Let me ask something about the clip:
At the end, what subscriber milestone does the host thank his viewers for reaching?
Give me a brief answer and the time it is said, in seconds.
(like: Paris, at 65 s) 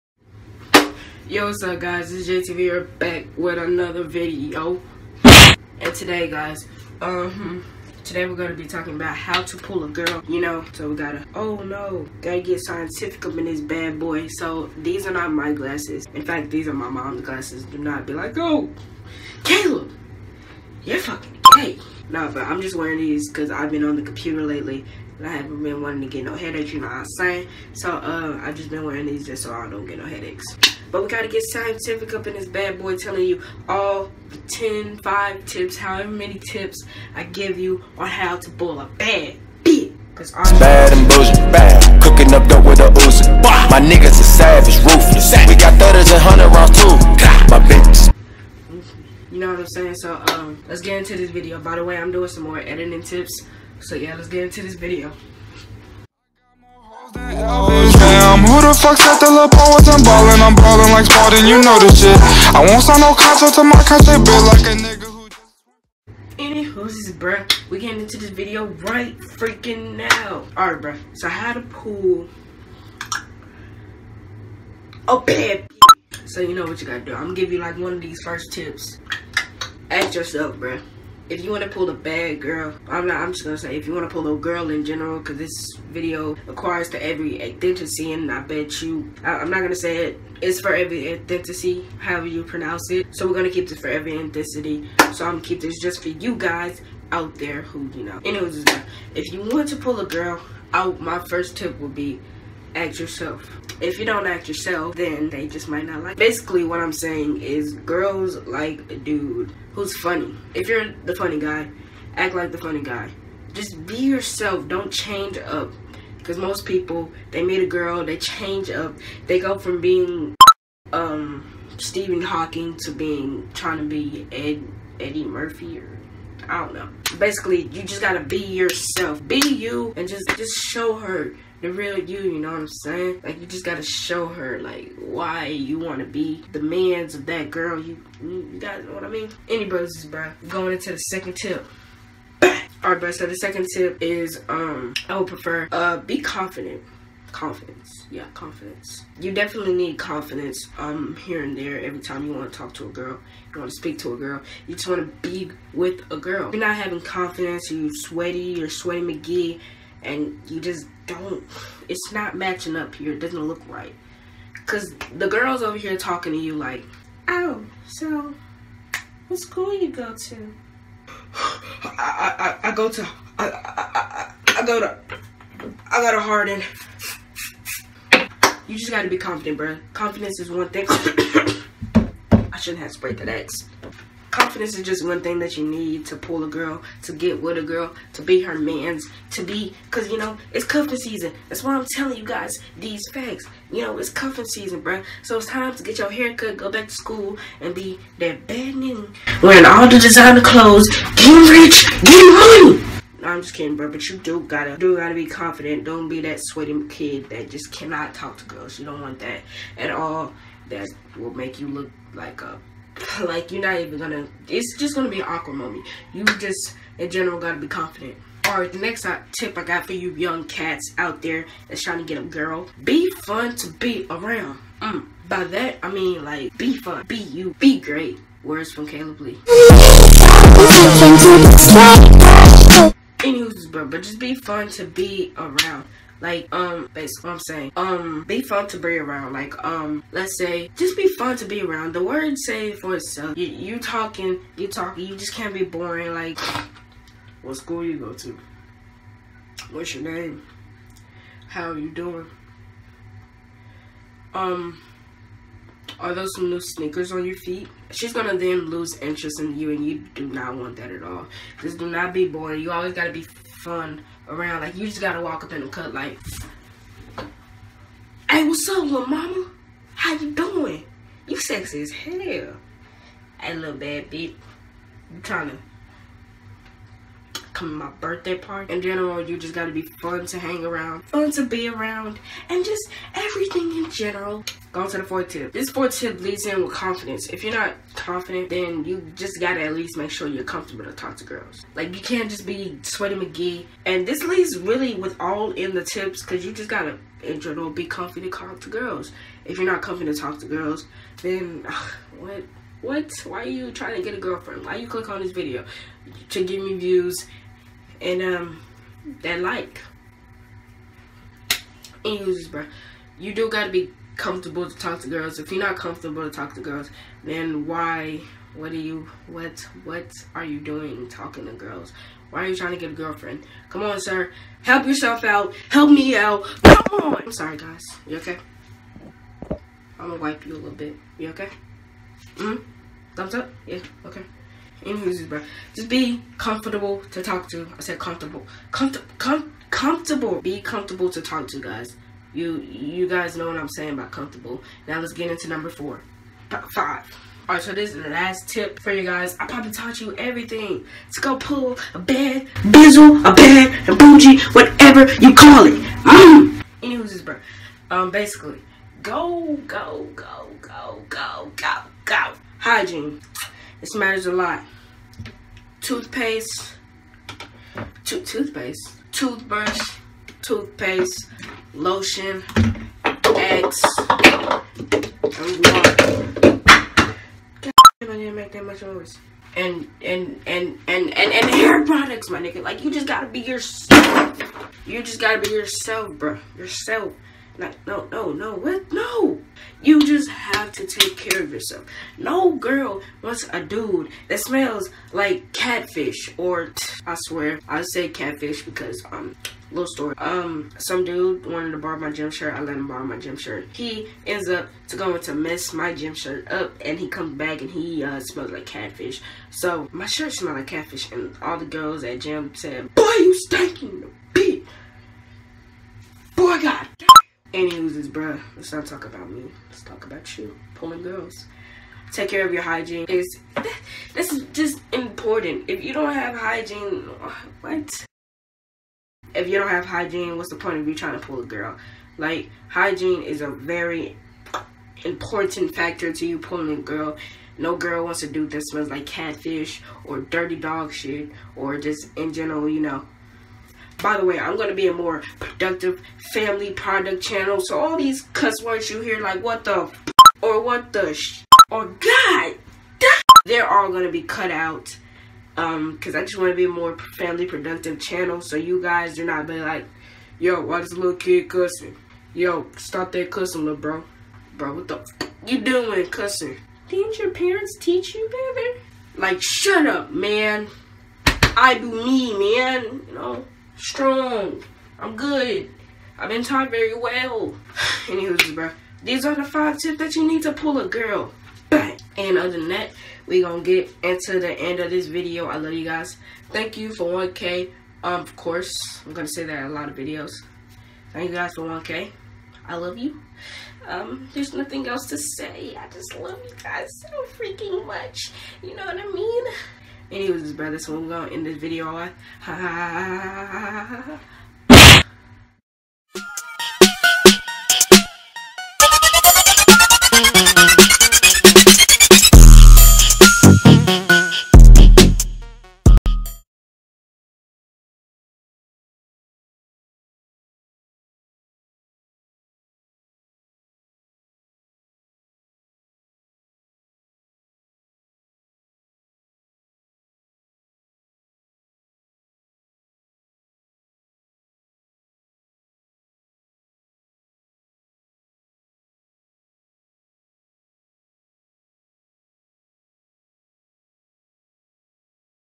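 1K, at 486 s.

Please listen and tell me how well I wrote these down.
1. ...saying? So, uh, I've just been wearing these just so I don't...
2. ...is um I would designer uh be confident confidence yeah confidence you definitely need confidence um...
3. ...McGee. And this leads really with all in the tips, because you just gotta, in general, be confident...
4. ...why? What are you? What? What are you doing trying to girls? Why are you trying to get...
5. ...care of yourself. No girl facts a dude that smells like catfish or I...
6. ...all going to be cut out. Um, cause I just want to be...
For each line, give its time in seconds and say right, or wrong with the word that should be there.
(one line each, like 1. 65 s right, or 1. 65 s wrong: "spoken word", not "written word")
1. 27 s right
2. 144 s wrong: "prefer", not "designer"
3. 293 s right
4. 317 s wrong: "talking", not "trying"
5. 391 s wrong: "wants", not "facts"
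6. 453 s right.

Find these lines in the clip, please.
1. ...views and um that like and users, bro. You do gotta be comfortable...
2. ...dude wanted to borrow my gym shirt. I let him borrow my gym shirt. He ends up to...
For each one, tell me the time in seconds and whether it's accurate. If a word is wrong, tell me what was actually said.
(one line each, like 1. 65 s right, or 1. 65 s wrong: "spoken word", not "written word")
1. 306 s right
2. 401 s right.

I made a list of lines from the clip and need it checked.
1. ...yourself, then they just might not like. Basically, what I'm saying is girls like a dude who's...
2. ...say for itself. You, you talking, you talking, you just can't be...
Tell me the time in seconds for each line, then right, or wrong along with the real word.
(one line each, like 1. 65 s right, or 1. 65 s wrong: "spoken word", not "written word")
1. 104 s right
2. 242 s right.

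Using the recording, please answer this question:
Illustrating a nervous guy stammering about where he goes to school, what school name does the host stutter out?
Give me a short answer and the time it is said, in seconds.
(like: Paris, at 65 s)
Harden, at 176 s.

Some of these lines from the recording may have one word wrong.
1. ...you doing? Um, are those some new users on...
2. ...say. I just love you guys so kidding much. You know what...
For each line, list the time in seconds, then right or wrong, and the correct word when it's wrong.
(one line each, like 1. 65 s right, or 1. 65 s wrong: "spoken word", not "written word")
1. 251 s wrong: "sneakers", not "users"
2. 495 s wrong: "freaking", not "kidding".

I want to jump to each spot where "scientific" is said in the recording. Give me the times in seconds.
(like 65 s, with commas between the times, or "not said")
12 s, 31 s.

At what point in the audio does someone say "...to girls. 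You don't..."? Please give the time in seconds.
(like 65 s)
208 s.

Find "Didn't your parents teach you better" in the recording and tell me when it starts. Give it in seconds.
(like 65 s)
466 s.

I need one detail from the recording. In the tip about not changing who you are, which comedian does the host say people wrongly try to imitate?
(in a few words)
Eddie Murphy.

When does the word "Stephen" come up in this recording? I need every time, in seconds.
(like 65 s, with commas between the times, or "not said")
121 s.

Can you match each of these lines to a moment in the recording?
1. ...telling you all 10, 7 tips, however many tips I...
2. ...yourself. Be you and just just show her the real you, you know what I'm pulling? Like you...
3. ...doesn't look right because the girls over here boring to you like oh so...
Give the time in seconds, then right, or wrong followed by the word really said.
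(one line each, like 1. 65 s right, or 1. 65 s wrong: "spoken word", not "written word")
1. 32 s wrong: "5", not "7"
2. 128 s wrong: "saying", not "pulling"
3. 163 s wrong: "talking", not "boring".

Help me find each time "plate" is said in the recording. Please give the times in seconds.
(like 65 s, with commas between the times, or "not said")
not said.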